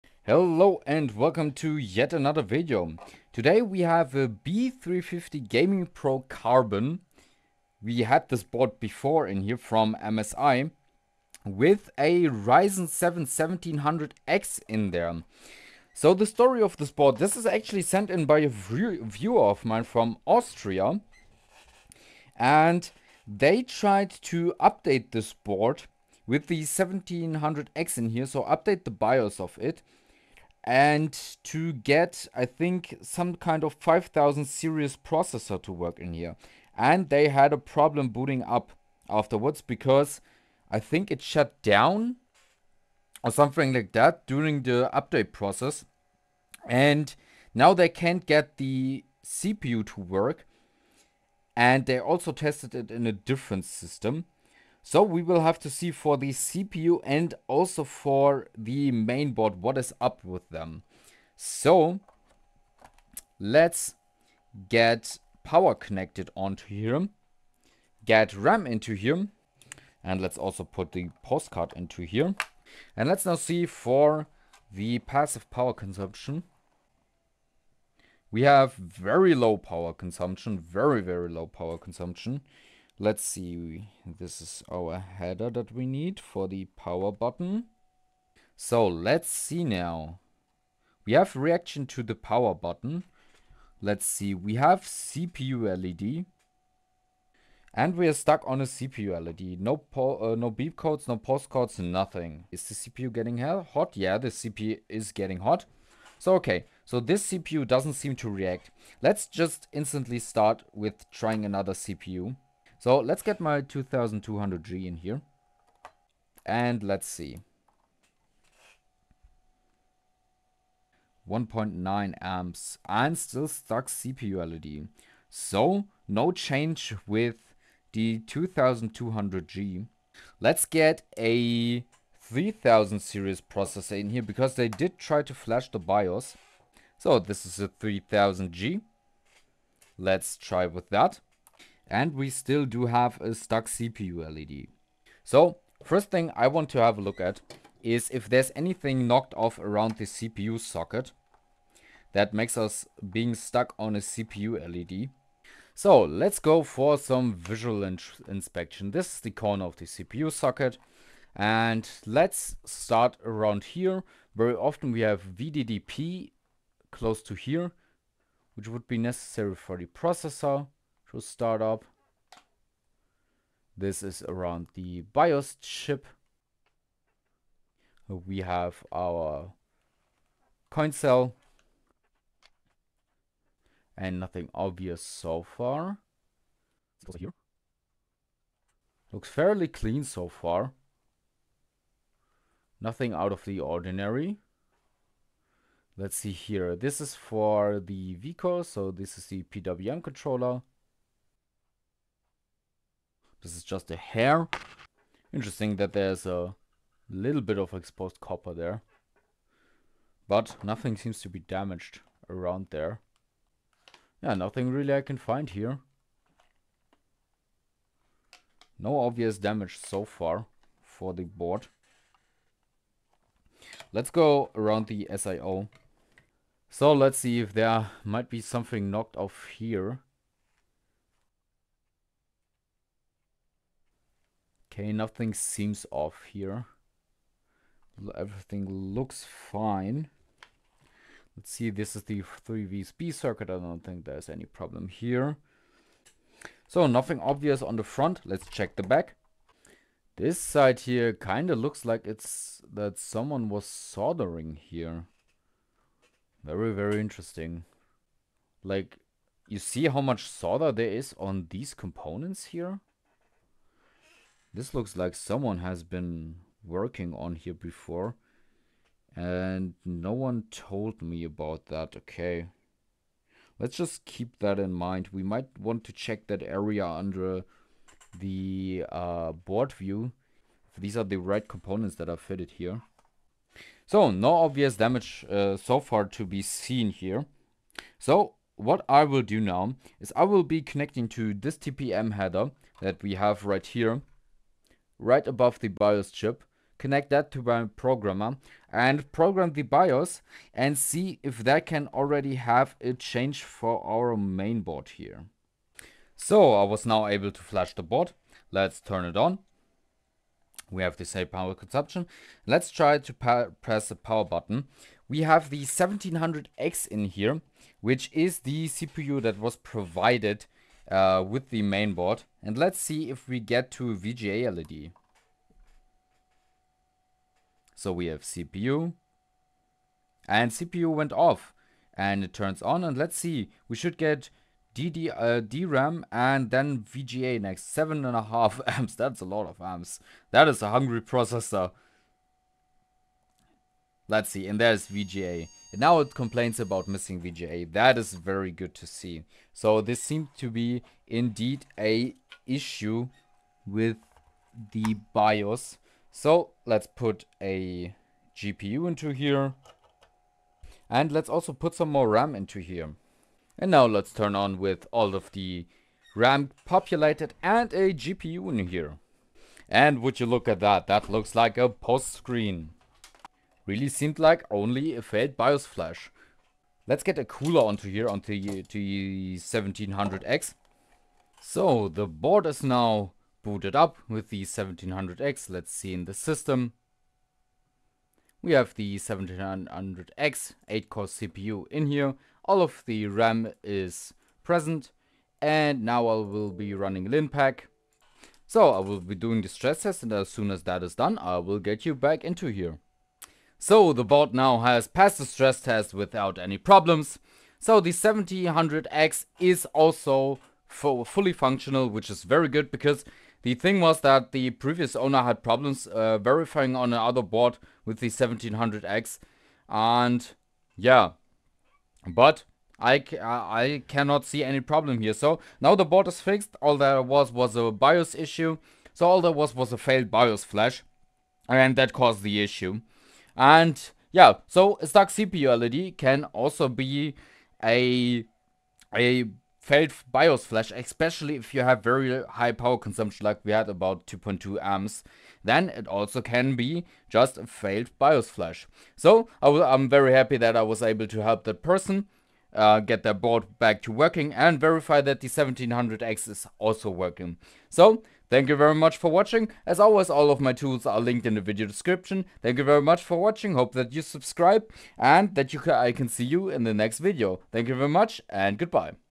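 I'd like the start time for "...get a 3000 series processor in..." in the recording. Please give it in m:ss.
2:10.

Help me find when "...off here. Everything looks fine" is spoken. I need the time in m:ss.
3:55.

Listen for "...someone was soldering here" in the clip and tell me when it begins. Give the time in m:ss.
4:12.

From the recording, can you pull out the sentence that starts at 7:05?
So now the board is fixed.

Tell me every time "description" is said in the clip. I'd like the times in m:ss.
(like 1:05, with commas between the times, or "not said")
7:41.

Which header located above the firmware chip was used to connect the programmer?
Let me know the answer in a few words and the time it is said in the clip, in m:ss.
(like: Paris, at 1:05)
TPM header, at 4:51.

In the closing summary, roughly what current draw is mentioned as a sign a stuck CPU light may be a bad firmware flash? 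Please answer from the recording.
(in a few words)
2.2 amps.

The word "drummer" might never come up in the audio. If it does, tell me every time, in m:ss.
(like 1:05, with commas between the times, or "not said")
not said.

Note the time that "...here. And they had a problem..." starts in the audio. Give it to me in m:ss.
0:36.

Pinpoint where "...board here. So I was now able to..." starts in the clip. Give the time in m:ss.
5:04.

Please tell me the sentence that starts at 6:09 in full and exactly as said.
And would you look at that, that looks like a post screen.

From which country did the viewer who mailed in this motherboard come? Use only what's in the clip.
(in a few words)
Austria.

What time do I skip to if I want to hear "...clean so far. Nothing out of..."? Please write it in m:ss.
3:09.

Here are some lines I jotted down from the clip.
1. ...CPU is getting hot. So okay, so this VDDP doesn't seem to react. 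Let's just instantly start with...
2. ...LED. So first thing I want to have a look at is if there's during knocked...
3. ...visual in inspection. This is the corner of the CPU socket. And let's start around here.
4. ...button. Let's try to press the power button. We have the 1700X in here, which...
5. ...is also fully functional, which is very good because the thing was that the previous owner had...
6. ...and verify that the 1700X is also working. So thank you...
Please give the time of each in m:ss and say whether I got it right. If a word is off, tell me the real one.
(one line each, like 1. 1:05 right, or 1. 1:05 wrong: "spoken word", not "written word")
1. 1:44 wrong: "CPU", not "VDDP"
2. 2:24 wrong: "anything", not "during"
3. 2:37 right
4. 5:11 wrong: "consumption", not "button"
5. 6:49 right
6. 7:34 right.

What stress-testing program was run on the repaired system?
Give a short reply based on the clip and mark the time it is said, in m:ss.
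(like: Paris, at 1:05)
LinPack, at 6:37.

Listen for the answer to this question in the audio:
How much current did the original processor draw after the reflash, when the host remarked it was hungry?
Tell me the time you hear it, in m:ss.
5:37.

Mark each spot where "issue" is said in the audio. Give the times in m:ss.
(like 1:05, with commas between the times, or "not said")
5:52, 7:08, 7:12.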